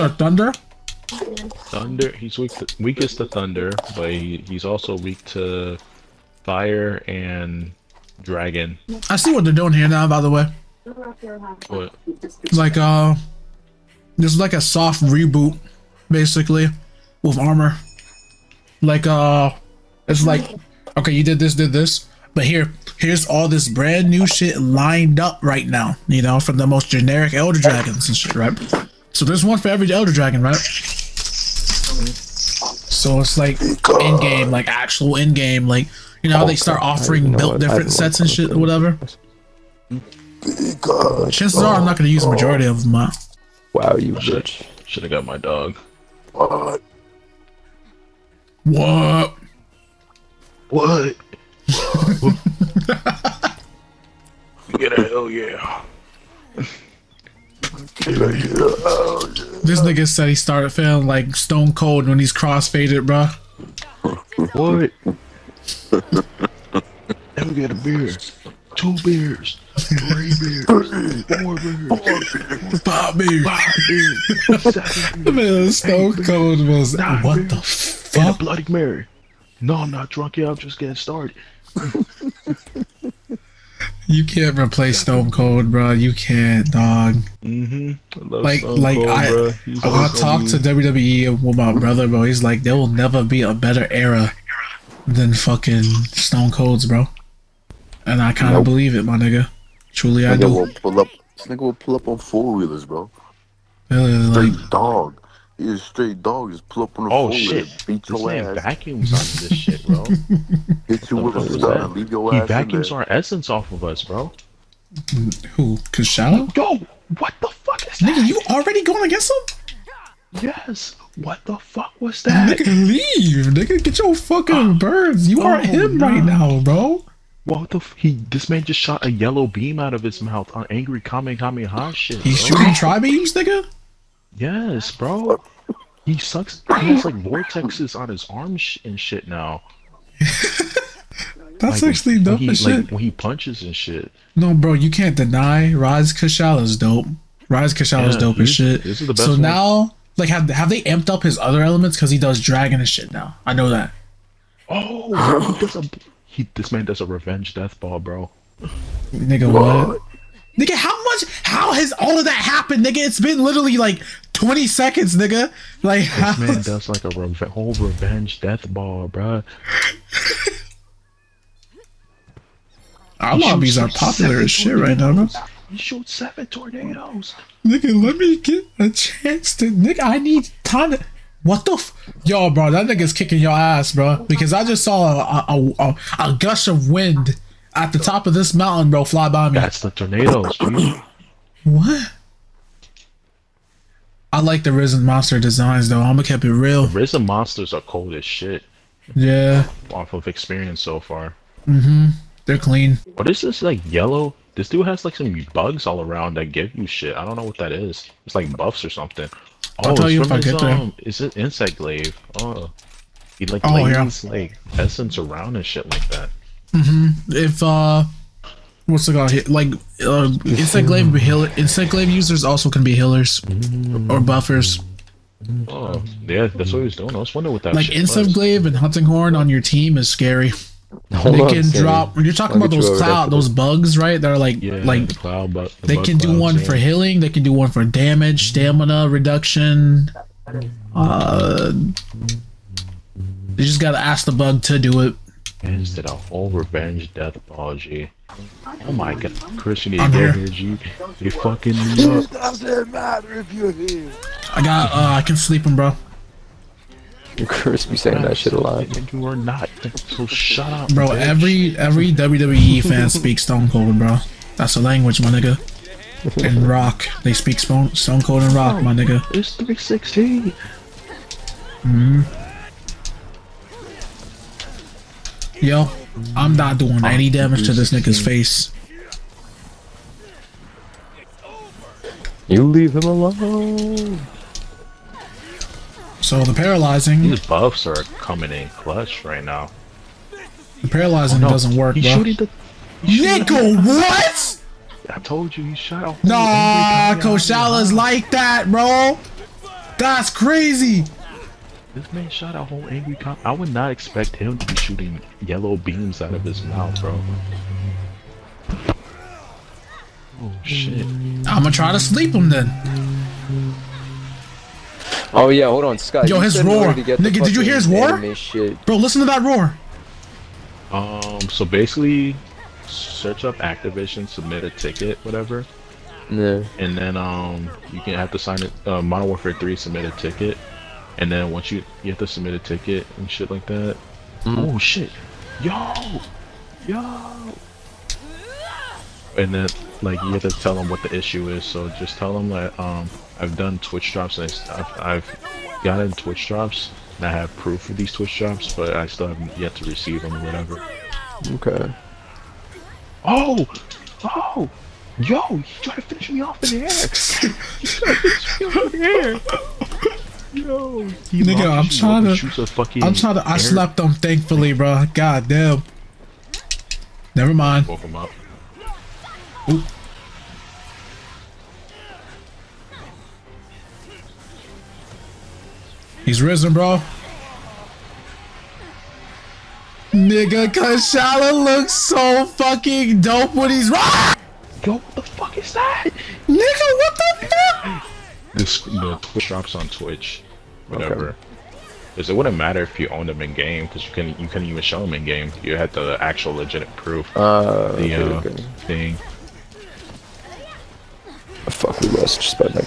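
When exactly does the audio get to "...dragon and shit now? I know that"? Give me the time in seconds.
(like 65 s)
152 s.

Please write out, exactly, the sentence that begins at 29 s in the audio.
So there's one for every Elder Dragon, right?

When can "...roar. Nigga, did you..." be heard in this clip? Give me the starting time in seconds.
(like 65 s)
316 s.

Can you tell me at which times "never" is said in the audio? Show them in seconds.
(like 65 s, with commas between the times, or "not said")
92 s, 367 s.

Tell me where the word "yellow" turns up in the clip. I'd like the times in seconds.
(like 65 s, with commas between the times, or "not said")
129 s, 203 s, 305 s.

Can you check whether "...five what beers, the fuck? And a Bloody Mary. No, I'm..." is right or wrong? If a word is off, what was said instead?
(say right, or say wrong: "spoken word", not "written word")
wrong: "nine", not "five".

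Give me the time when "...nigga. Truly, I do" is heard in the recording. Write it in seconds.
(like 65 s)
99 s.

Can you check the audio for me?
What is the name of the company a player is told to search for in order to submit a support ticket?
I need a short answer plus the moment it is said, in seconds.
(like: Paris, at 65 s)
Activision, at 322 s.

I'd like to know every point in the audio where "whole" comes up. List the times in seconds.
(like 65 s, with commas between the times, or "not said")
167 s, 302 s.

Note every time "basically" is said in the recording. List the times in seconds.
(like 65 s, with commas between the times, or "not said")
16 s, 321 s.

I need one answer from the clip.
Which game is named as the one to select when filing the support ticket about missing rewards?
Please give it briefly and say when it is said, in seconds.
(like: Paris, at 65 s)
Modern Warfare 3, at 329 s.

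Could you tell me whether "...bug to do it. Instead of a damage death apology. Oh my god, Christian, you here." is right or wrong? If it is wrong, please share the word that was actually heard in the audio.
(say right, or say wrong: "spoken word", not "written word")
wrong: "revenge", not "damage".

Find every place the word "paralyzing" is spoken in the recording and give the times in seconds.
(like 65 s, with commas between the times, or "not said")
286 s, 290 s.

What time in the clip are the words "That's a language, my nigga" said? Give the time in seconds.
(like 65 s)
264 s.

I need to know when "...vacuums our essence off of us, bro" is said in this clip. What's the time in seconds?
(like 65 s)
112 s.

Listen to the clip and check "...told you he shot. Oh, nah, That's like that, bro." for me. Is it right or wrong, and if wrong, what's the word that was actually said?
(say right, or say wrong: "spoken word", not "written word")
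wrong: "Kushala", not "That".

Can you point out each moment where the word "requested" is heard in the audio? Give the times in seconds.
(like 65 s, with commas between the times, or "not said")
not said.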